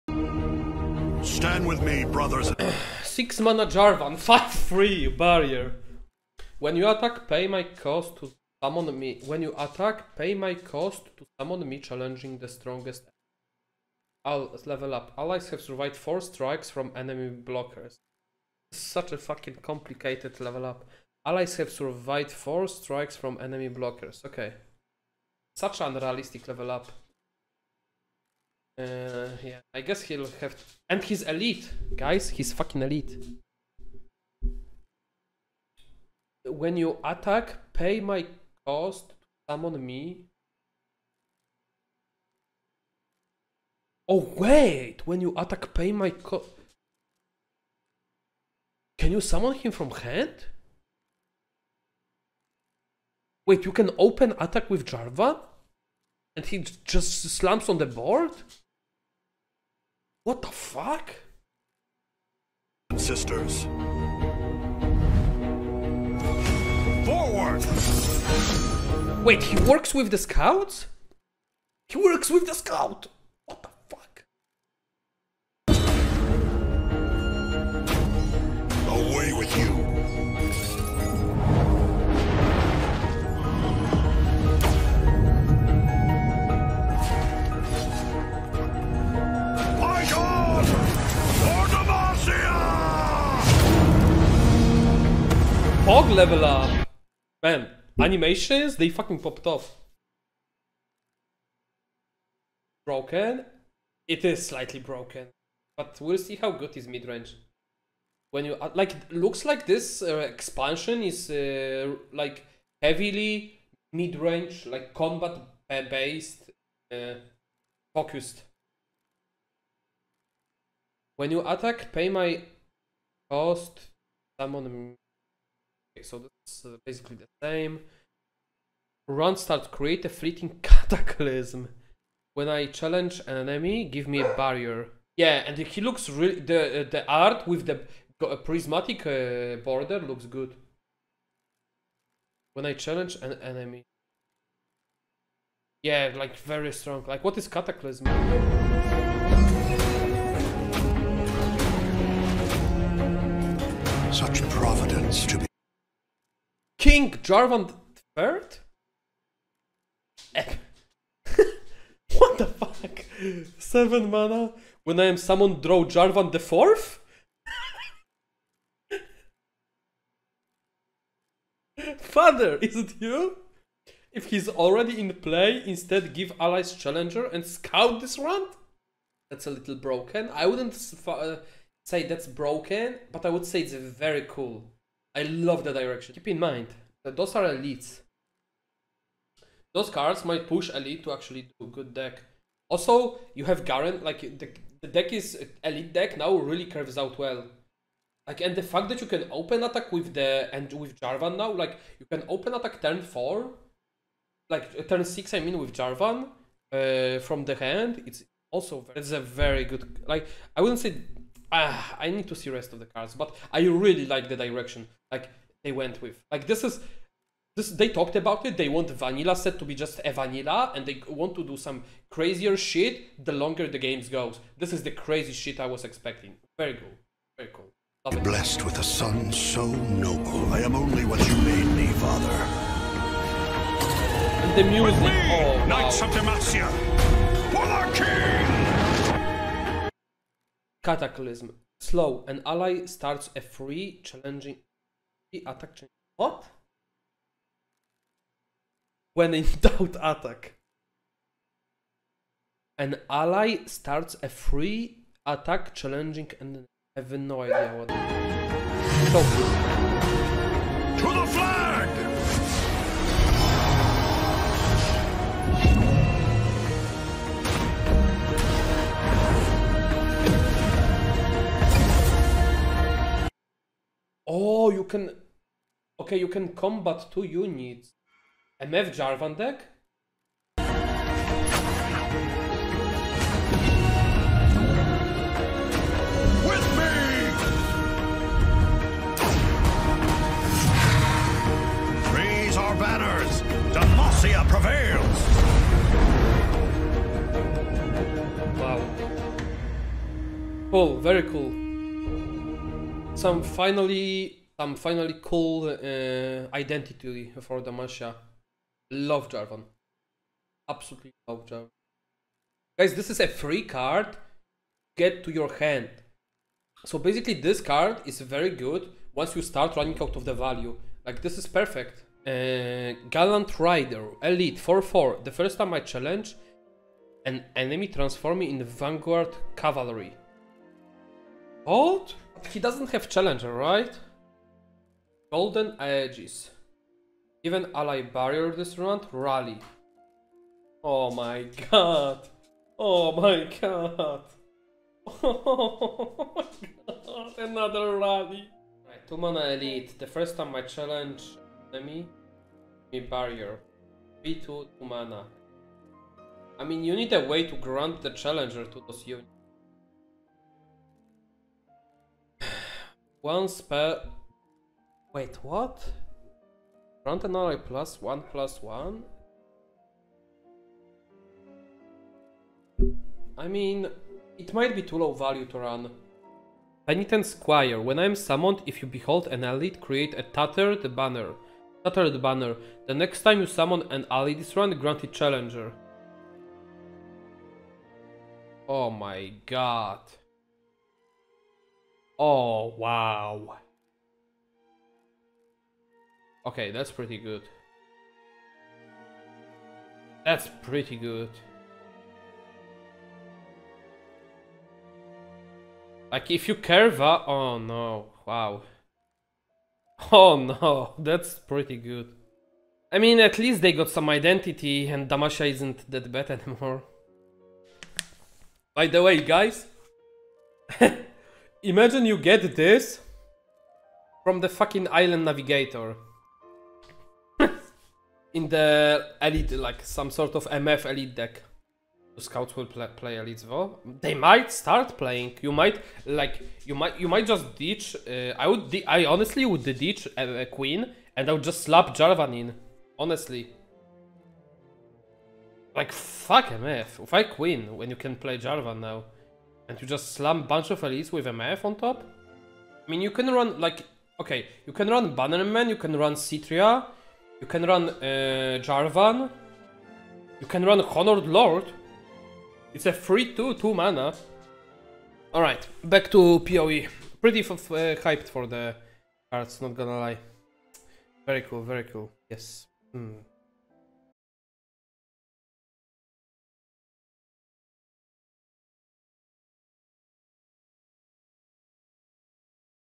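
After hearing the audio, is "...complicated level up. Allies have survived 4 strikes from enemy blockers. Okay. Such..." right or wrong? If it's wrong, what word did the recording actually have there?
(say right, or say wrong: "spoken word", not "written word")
right.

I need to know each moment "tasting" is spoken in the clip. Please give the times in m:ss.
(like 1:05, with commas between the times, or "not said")
not said.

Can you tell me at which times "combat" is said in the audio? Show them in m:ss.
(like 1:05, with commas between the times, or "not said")
1:54, 4:36.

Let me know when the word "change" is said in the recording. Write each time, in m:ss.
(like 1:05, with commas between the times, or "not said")
4:05.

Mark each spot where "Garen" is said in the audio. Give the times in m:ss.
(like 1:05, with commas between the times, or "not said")
3:13.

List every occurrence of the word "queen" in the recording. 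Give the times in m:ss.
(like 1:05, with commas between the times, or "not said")
7:20, 7:27.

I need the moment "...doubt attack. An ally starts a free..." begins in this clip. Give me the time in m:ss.
4:09.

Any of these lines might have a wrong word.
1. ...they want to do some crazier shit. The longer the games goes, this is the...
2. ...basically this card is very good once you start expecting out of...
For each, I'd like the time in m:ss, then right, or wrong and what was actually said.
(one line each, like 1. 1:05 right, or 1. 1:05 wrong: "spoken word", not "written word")
1. 3:40 right
2. 5:16 wrong: "running", not "expecting".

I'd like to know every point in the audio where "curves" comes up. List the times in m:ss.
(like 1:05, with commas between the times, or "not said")
3:16, 6:46.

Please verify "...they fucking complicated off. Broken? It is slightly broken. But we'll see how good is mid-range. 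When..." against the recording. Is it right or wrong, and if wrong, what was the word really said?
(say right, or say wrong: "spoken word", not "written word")
wrong: "popped", not "complicated".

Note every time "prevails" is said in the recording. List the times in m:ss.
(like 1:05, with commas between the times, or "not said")
4:54.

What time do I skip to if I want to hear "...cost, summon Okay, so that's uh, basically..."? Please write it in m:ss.
2:03.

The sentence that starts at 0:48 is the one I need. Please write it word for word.
Can you summon him from hand?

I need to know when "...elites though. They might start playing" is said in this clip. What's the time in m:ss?
7:13.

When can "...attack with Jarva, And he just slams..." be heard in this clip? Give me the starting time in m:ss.
0:54.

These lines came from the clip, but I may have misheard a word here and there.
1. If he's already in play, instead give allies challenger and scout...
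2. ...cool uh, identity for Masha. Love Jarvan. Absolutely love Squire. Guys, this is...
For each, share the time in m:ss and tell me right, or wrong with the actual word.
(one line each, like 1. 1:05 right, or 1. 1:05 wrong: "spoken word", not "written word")
1. 2:54 right
2. 5:05 wrong: "Jarvan", not "Squire".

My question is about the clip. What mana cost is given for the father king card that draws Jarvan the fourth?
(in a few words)
Seven.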